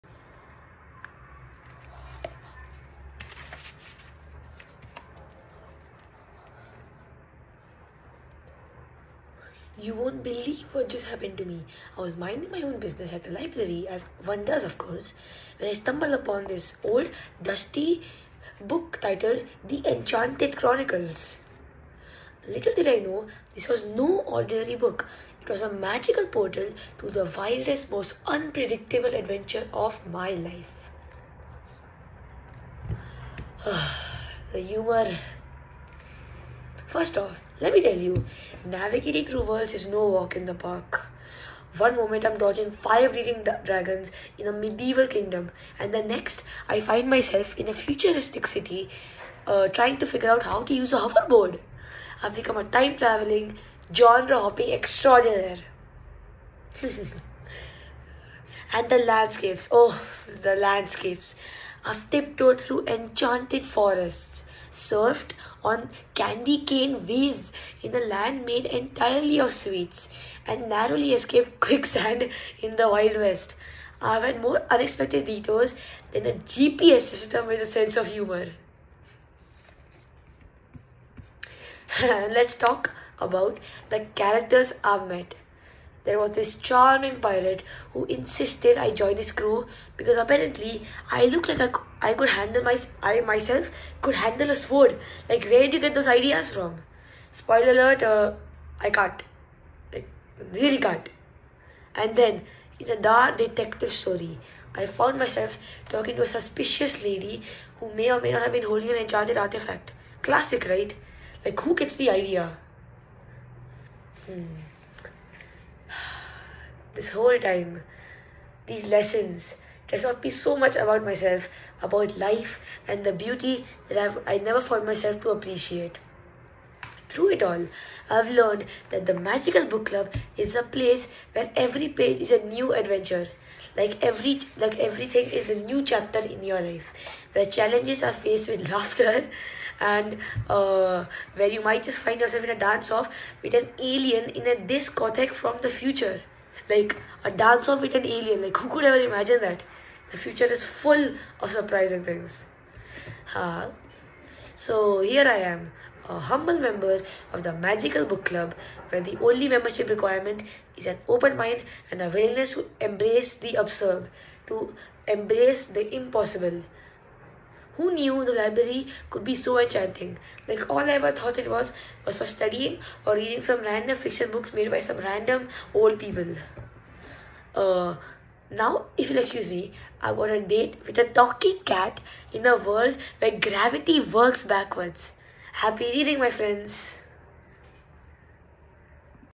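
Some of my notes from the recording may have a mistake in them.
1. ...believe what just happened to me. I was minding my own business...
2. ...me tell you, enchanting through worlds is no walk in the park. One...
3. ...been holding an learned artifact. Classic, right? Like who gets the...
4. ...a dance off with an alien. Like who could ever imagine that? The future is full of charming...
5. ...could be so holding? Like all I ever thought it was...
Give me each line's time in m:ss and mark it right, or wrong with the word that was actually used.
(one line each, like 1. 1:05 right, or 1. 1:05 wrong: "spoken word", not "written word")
1. 0:10 right
2. 0:37 wrong: "navigating", not "enchanting"
3. 1:48 wrong: "enchanted", not "learned"
4. 2:27 wrong: "surprising", not "charming"
5. 2:49 wrong: "enchanting", not "holding".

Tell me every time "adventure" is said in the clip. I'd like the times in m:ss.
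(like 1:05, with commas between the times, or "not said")
0:29, 2:12.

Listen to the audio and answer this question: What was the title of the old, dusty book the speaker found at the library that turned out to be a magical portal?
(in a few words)
The Enchanted Chronicles.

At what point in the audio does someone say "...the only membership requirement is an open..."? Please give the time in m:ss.
2:39.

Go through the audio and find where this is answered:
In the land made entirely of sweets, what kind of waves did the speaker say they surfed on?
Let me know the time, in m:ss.
1:06.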